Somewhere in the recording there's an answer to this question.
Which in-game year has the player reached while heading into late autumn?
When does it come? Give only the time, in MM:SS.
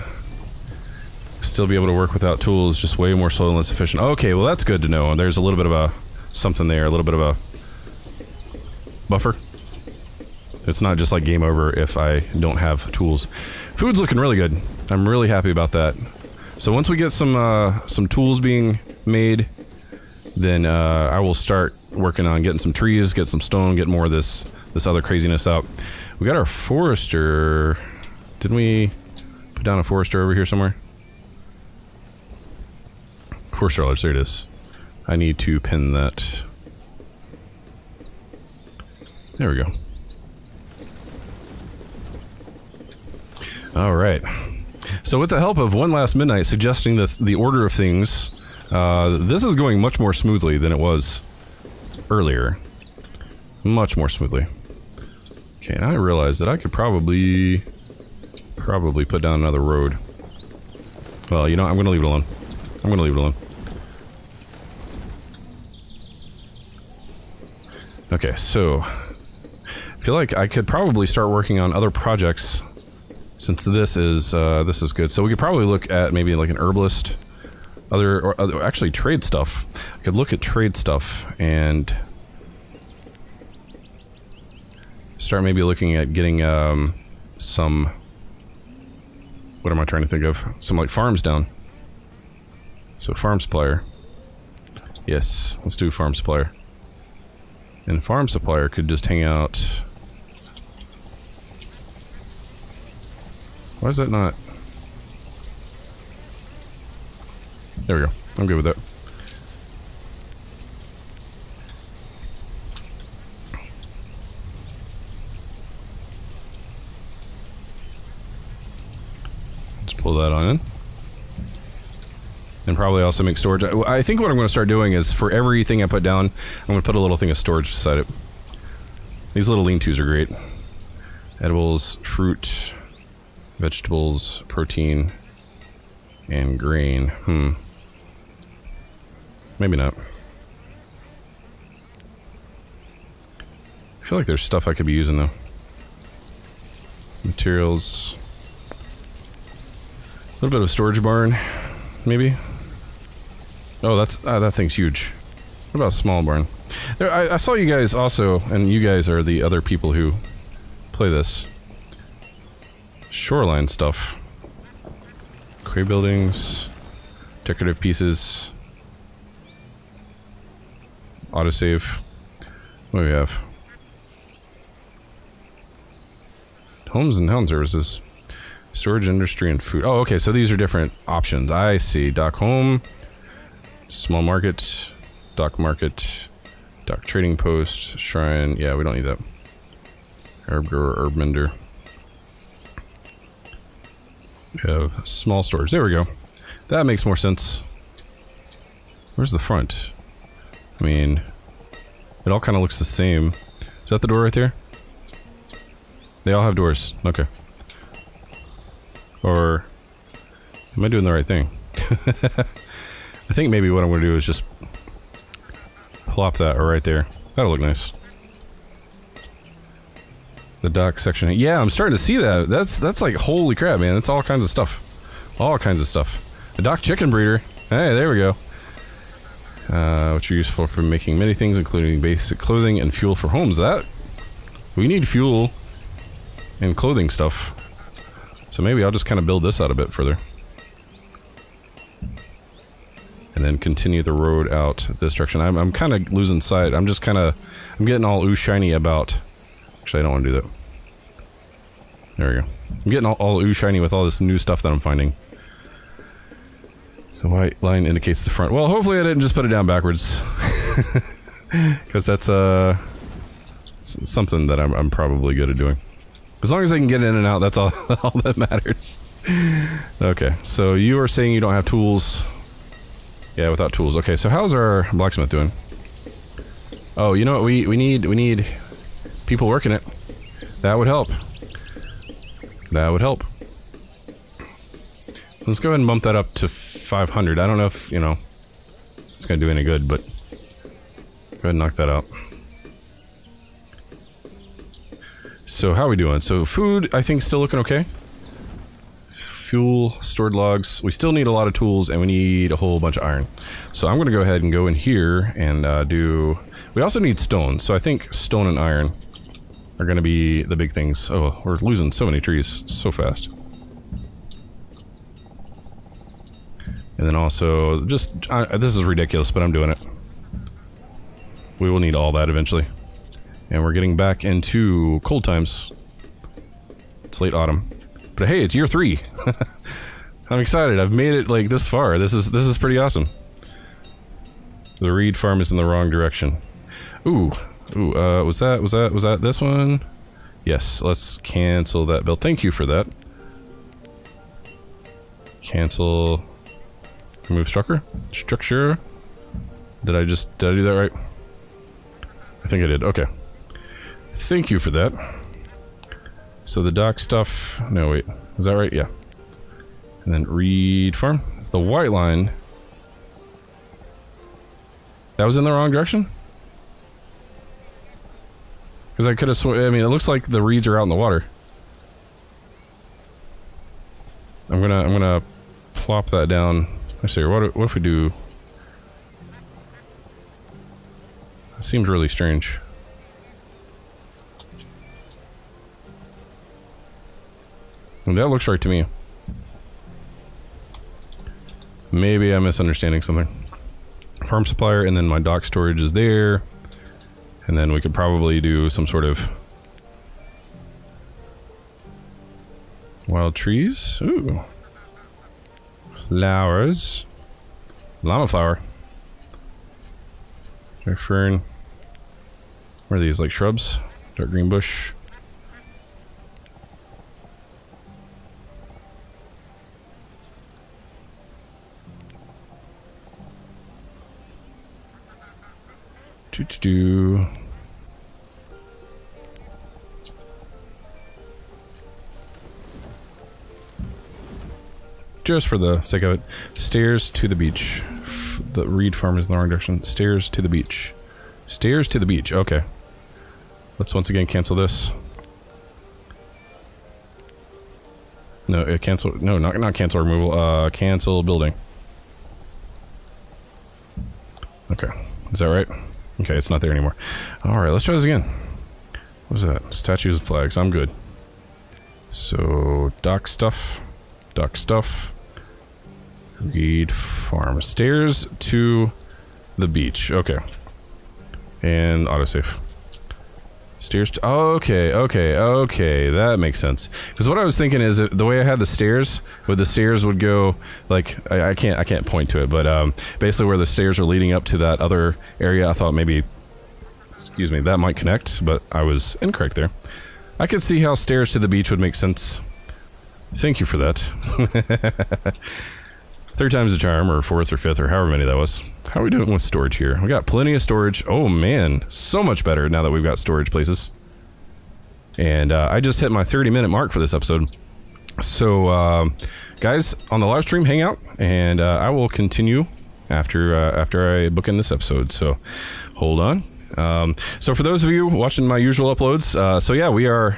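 05:28.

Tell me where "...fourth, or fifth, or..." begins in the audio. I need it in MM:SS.
08:17.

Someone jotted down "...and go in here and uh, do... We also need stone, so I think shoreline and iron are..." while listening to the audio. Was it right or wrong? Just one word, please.
wrong.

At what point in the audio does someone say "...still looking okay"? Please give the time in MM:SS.
04:57.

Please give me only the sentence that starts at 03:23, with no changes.
Is that the door right there?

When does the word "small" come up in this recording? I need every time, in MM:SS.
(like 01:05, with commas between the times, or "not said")
02:35, 03:03, 03:15.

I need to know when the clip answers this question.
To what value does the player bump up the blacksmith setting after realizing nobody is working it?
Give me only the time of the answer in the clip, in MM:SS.
04:46.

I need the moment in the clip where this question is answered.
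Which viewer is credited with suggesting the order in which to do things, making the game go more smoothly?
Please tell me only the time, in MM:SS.
00:45.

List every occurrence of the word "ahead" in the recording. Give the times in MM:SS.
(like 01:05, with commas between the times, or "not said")
04:45, 04:51, 05:04.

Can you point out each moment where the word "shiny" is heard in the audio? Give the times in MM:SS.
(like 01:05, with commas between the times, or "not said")
04:08, 04:13.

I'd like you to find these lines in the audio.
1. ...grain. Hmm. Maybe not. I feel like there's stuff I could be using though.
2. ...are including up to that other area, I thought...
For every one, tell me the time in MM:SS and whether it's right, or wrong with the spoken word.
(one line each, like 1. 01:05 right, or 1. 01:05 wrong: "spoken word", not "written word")
1. 02:16 right
2. 08:03 wrong: "leading", not "including".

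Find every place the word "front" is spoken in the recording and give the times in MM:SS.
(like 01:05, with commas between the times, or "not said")
03:19, 04:18.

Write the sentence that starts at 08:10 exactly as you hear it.
I could see how stairs to the beach would make sense.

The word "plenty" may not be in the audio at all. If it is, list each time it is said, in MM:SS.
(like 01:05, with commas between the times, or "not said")
08:20.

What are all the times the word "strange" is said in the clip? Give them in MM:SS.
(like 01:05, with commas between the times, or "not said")
06:22.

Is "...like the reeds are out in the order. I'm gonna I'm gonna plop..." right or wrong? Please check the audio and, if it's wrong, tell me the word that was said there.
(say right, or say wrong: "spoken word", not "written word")
wrong: "water", not "order".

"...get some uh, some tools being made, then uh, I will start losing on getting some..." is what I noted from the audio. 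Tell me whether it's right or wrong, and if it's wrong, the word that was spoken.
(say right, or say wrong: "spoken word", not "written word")
wrong: "working", not "losing".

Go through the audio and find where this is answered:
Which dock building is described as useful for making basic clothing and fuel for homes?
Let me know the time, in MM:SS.
03:46.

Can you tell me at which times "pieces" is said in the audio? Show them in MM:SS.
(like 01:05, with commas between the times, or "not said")
02:47.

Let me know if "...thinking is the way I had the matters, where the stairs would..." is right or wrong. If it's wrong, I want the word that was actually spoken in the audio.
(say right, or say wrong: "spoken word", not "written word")
wrong: "stairs", not "matters".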